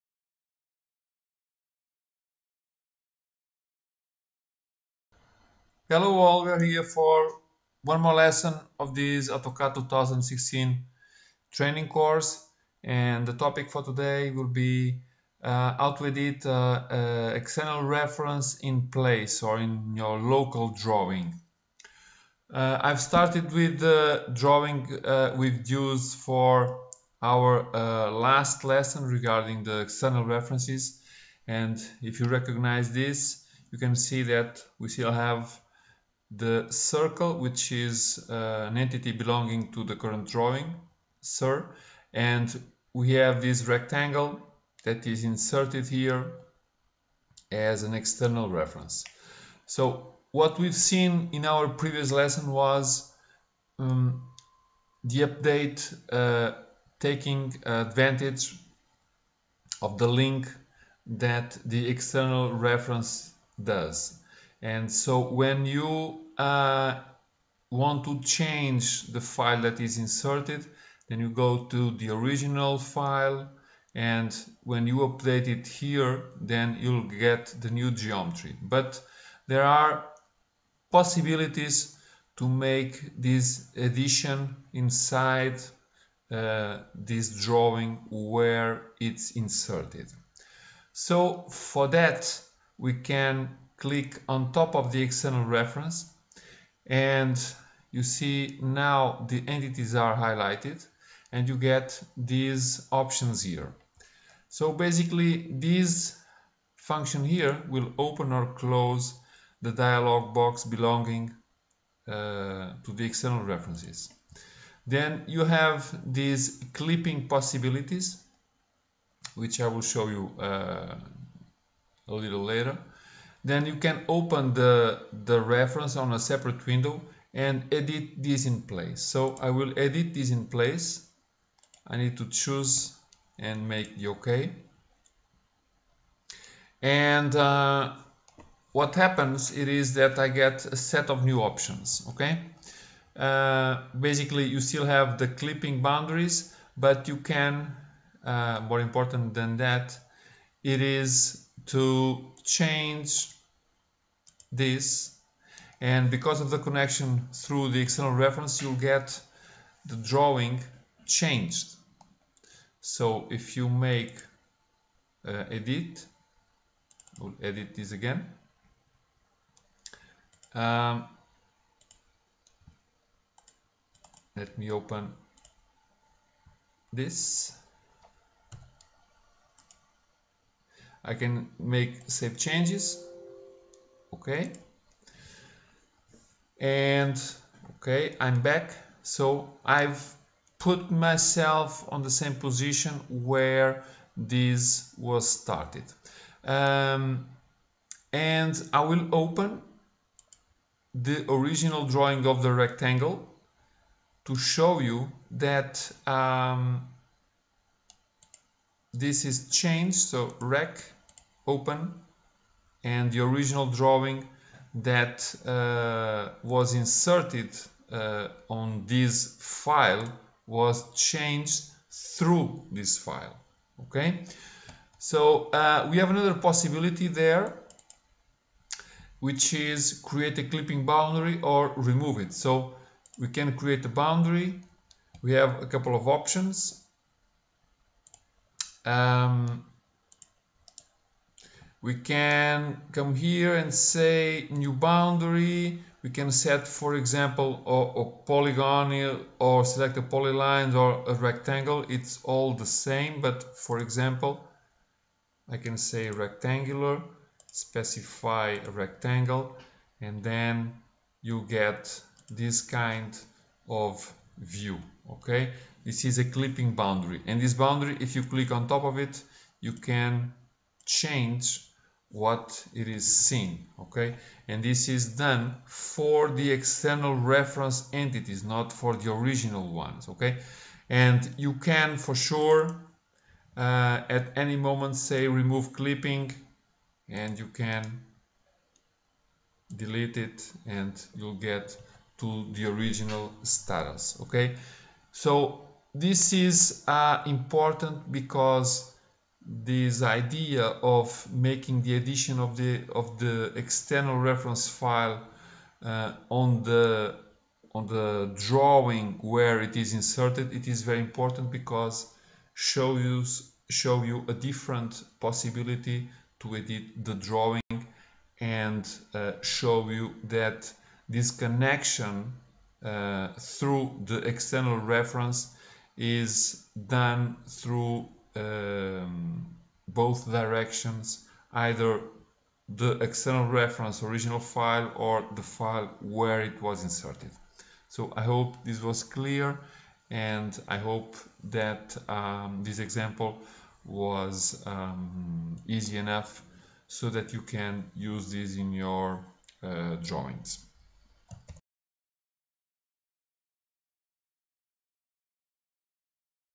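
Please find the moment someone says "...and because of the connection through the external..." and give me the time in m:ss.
2:35.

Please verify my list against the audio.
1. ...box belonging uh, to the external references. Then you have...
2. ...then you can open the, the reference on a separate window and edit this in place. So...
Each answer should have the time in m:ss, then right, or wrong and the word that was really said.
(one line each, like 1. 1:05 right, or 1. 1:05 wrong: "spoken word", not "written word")
1. 1:50 right
2. 2:03 right.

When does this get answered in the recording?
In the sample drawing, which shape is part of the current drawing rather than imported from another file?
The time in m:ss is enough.
0:36.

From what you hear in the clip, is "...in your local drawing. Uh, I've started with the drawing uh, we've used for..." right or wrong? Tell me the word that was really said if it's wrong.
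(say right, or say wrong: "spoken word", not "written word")
right.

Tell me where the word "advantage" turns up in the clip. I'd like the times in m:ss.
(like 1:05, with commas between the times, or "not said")
0:57.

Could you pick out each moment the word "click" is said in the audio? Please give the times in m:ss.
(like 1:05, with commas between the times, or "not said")
1:33, 4:28.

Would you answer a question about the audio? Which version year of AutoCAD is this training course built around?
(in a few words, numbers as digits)
2016.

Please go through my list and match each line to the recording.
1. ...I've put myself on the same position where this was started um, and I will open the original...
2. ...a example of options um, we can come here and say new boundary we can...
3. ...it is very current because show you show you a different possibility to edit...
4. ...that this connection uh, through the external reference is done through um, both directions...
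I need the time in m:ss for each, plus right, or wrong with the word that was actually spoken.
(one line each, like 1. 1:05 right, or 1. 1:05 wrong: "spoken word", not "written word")
1. 3:09 right
2. 3:55 wrong: "couple", not "example"
3. 5:10 wrong: "important", not "current"
4. 5:20 right.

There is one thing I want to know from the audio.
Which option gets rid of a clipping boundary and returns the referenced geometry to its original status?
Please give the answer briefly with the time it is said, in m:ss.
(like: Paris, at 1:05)
Remove clipping, at 4:45.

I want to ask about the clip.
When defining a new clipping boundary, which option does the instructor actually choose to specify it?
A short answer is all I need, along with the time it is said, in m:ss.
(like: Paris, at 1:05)
Rectangular, at 4:16.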